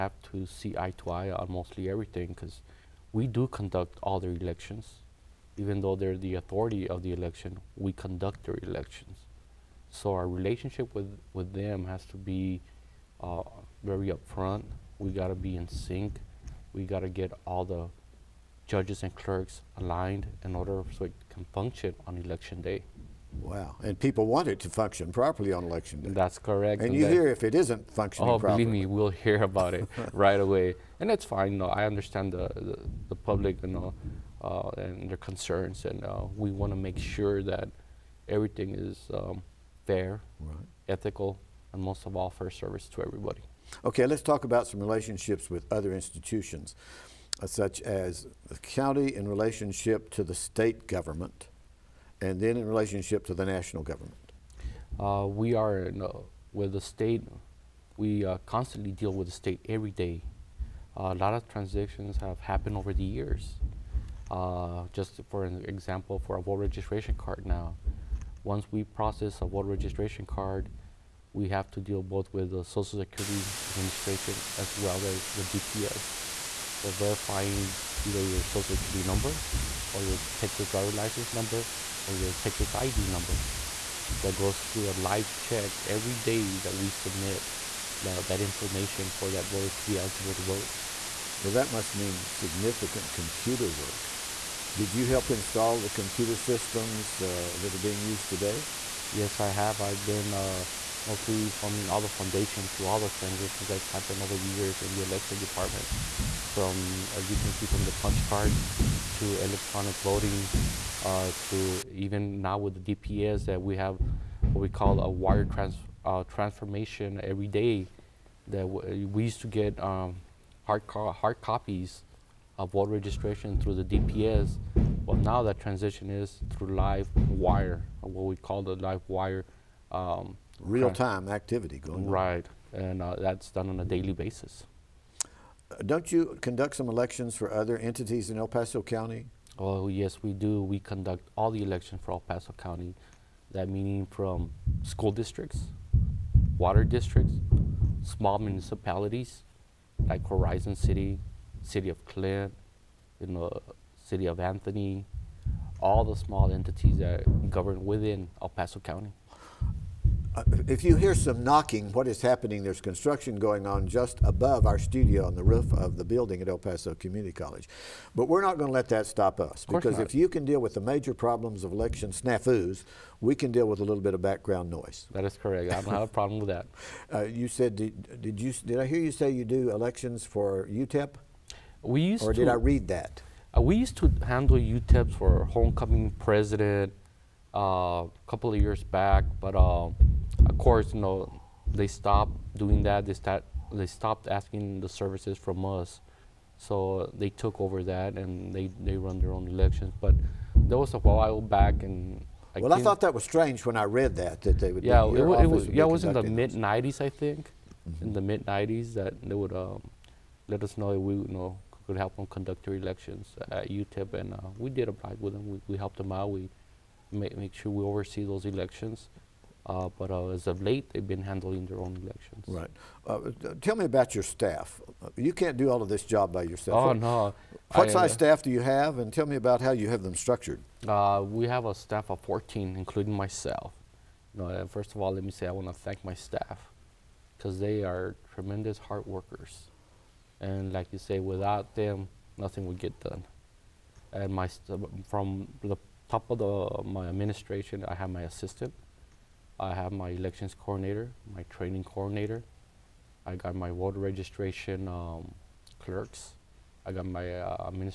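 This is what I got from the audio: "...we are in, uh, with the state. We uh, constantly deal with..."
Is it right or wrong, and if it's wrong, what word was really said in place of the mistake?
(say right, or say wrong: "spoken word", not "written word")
right.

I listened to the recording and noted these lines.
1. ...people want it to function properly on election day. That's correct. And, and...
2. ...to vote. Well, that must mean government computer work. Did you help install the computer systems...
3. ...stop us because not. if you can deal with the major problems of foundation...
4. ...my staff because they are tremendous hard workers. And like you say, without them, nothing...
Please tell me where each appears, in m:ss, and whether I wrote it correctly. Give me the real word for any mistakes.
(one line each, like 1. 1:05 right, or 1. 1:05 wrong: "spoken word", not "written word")
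1. 0:23 right
2. 1:30 wrong: "significant", not "government"
3. 2:49 wrong: "election", not "foundation"
4. 3:56 right.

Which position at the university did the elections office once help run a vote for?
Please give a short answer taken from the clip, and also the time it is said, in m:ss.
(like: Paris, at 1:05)
Homecoming president, at 3:05.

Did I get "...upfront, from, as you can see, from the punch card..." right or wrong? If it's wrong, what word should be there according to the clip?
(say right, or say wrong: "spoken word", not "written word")
wrong: "department", not "upfront".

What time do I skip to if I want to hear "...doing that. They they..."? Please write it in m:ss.
3:12.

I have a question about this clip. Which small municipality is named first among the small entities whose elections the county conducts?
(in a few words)
Horizon City.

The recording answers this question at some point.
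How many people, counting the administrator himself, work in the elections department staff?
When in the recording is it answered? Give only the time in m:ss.
3:52.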